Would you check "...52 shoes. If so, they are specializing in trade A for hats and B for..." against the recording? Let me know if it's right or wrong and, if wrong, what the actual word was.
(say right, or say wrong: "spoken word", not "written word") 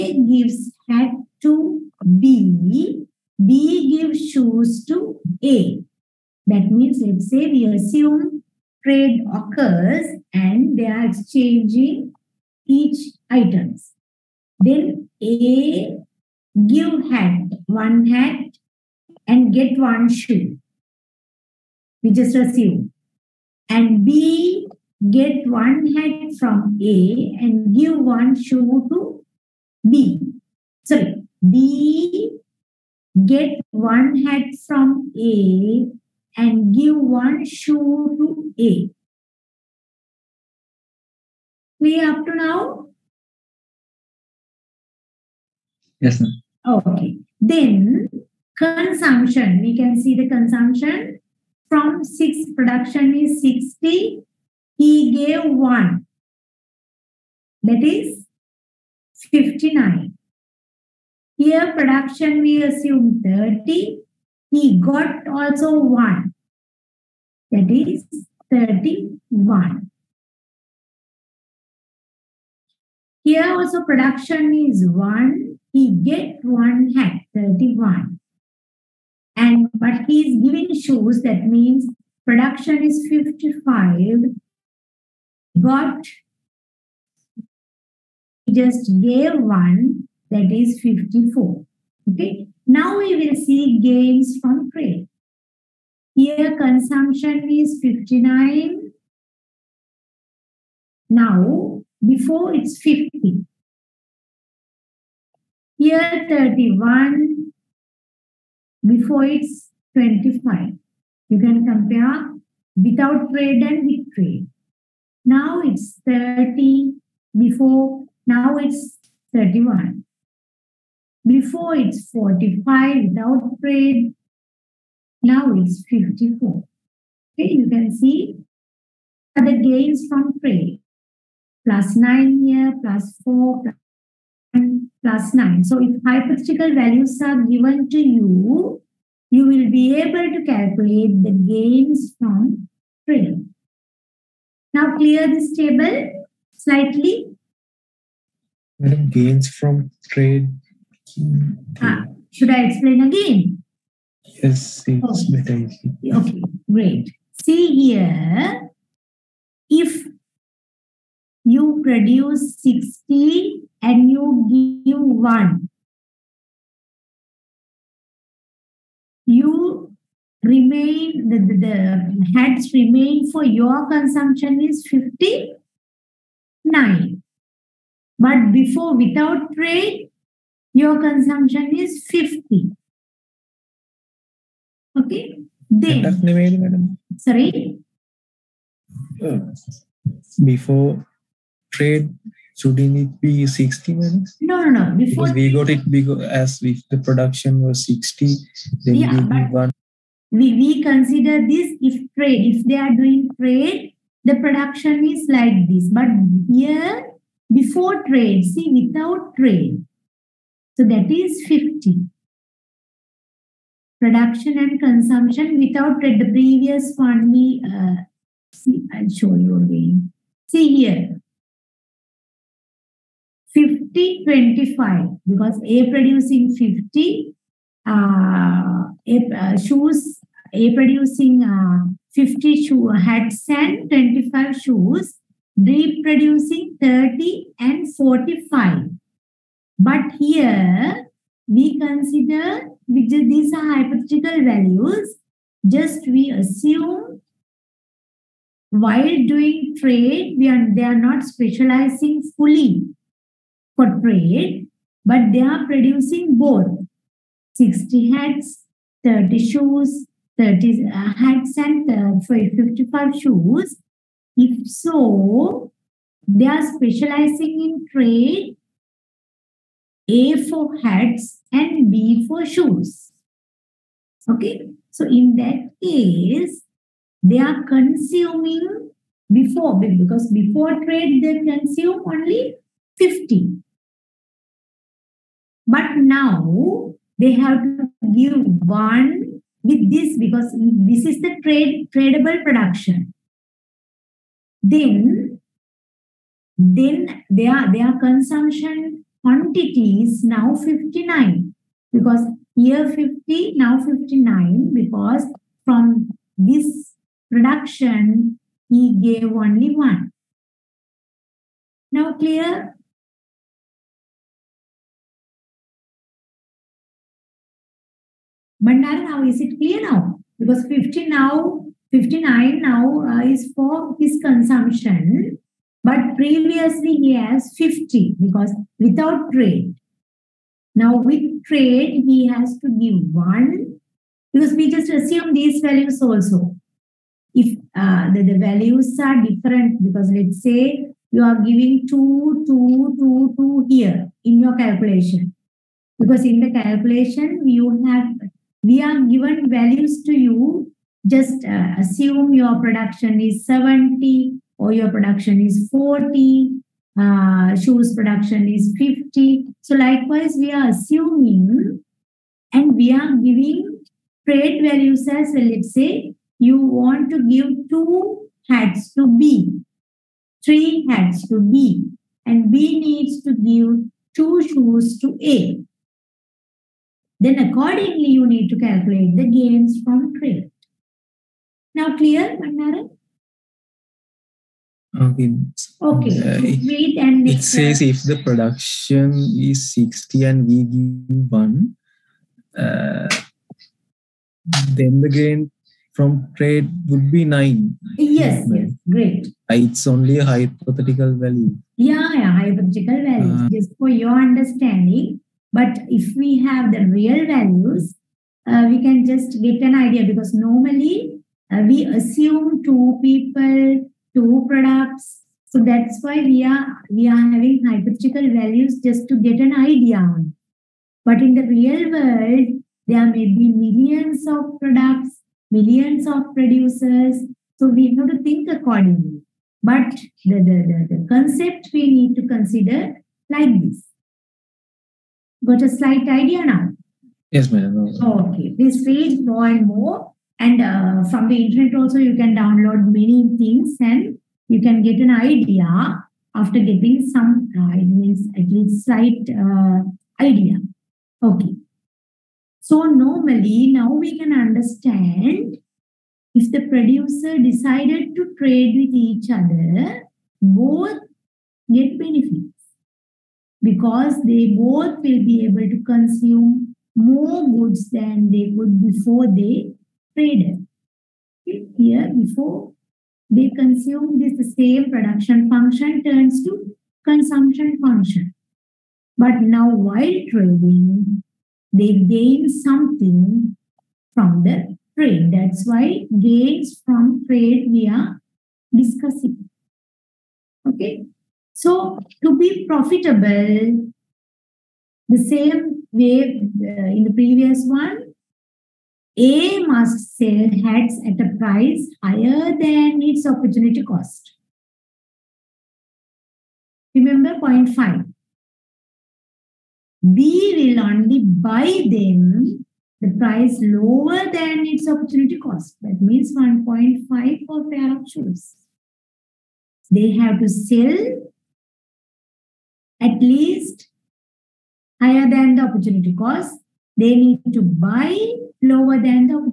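wrong: "55", not "52".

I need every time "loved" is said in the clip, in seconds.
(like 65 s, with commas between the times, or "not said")
not said.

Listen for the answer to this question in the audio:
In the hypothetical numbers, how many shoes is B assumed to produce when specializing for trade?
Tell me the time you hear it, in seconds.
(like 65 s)
82 s.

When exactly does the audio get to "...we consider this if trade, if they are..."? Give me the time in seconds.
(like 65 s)
200 s.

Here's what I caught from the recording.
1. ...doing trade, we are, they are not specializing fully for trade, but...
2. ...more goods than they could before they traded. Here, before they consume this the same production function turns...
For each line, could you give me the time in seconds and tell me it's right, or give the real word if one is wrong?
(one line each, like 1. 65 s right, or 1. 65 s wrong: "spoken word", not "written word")
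1. 249 s right
2. 466 s right.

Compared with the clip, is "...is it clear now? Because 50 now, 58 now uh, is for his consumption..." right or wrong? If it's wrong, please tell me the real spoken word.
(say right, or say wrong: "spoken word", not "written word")
wrong: "59", not "58".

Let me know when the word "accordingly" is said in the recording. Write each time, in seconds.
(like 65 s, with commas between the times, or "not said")
377 s, 428 s.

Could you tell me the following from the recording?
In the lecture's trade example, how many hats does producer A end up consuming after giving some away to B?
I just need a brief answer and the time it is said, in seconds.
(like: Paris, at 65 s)
59, at 57 s.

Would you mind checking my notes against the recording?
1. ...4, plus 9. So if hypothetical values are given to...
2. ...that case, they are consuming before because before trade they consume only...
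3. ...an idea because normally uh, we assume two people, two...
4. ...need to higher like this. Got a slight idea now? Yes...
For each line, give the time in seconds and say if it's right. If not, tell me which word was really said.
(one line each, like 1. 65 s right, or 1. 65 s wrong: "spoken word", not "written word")
1. 133 s right
2. 275 s right
3. 409 s right
4. 431 s wrong: "consider", not "higher".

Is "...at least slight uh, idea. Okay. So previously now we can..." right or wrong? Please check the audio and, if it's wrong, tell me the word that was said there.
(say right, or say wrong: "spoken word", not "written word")
wrong: "normally", not "previously".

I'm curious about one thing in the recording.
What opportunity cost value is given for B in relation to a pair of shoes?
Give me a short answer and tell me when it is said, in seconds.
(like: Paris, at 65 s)
1.5, at 516 s.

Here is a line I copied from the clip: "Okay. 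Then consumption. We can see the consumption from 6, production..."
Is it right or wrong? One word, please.
right.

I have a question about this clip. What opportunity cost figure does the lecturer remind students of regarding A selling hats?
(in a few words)
0.5.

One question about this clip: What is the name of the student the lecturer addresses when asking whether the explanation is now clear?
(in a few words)
Bandara.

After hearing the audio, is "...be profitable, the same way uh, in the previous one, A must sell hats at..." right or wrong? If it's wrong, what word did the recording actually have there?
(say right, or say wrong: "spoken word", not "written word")
right.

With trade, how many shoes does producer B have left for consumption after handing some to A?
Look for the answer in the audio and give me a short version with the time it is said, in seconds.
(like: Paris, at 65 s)
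54, at 90 s.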